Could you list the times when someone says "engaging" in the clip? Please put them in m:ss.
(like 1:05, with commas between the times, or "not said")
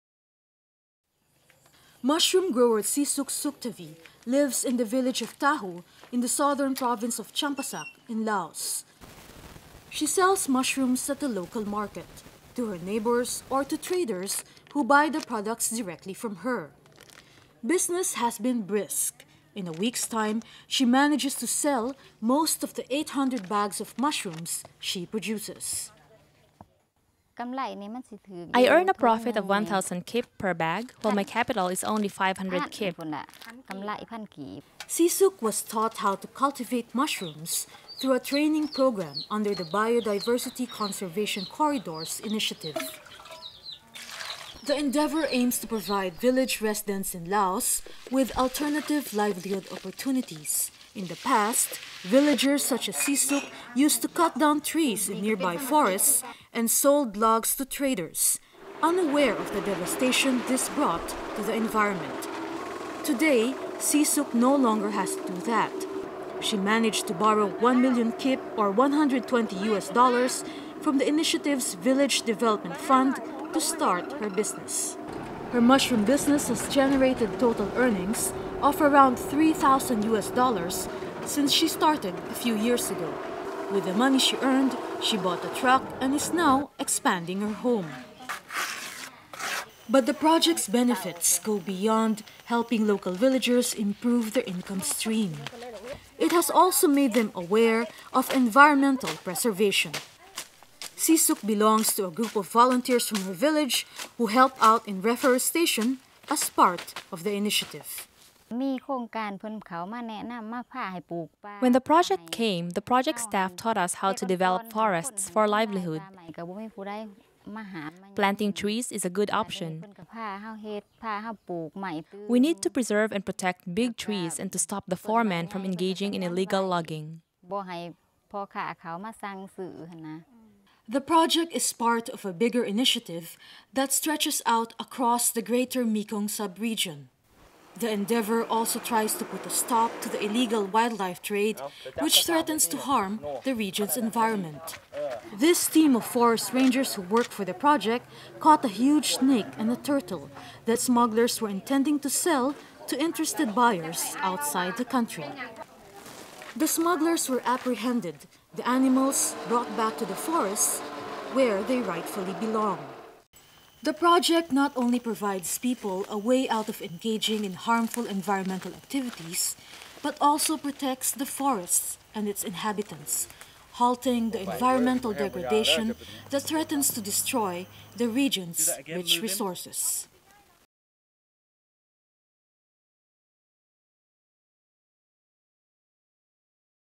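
2:05, 2:46.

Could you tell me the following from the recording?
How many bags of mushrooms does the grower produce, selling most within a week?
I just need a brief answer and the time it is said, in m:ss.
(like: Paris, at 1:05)
800, at 0:22.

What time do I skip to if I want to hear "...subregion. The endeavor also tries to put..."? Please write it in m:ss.
2:16.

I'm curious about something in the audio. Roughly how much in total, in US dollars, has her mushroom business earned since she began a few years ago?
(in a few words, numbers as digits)
3,000 US dollars.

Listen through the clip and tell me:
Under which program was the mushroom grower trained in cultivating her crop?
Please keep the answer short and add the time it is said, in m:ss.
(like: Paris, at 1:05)
Biodiversity Conservation Corridors Initiative, at 0:39.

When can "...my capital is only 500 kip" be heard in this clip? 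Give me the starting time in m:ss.
0:31.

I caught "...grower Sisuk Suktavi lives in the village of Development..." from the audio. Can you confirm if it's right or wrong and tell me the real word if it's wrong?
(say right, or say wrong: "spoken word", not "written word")
wrong: "Tahu", not "Development".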